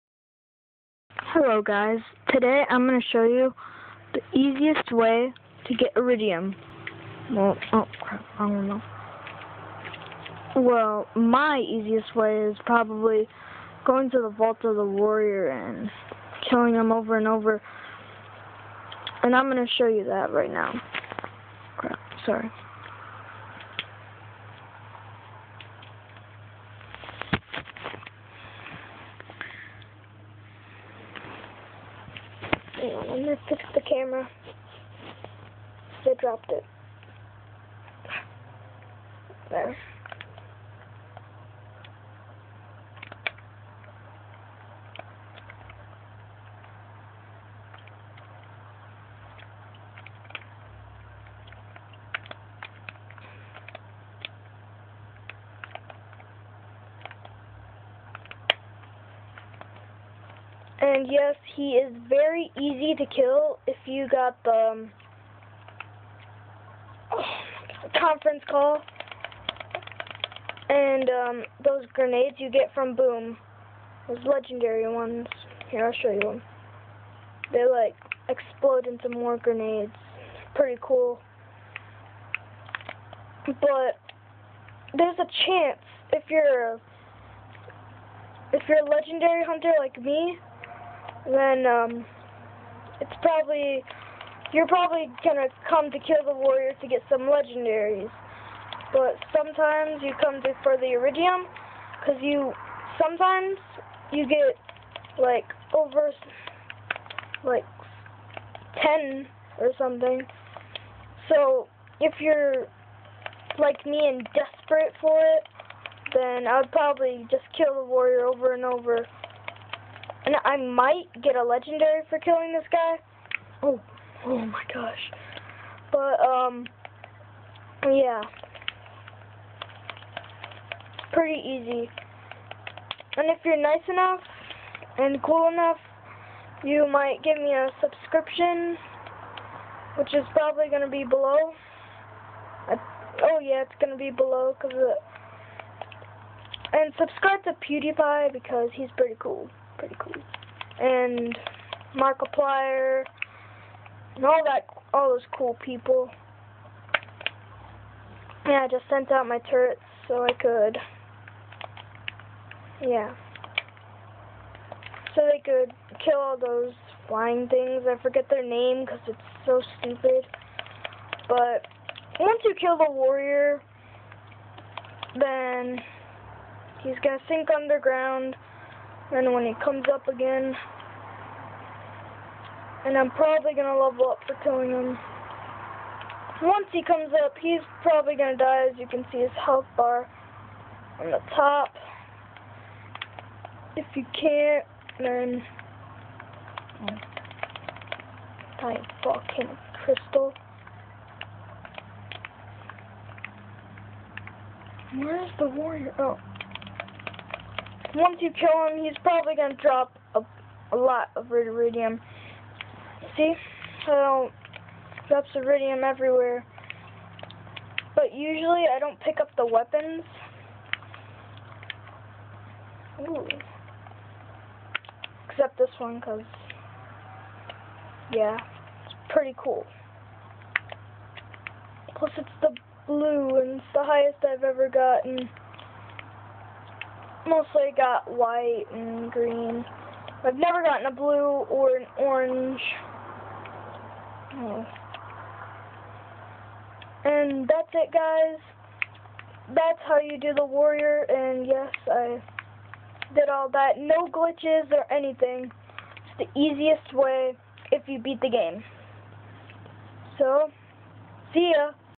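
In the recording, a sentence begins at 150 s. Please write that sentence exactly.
And Markiplier, and all that, all those cool people.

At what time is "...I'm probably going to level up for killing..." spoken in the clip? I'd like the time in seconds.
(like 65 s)
182 s.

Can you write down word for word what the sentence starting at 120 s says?
And I might get a legendary for killing this guy.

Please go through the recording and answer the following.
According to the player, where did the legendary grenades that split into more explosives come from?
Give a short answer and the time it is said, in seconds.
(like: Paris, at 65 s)
Boom, at 72 s.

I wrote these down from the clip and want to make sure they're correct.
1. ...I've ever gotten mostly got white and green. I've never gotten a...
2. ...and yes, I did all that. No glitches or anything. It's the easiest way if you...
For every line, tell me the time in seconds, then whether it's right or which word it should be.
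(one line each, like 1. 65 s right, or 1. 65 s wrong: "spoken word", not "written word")
1. 234 s right
2. 251 s right.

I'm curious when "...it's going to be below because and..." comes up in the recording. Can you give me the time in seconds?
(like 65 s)
143 s.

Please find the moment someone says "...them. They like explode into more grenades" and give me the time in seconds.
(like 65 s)
76 s.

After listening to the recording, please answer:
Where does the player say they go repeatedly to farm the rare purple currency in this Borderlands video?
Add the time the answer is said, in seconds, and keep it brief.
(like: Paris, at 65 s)
Vault of the Warrior, at 14 s.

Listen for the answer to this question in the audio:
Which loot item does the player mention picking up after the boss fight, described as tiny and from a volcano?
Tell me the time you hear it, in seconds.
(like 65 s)
198 s.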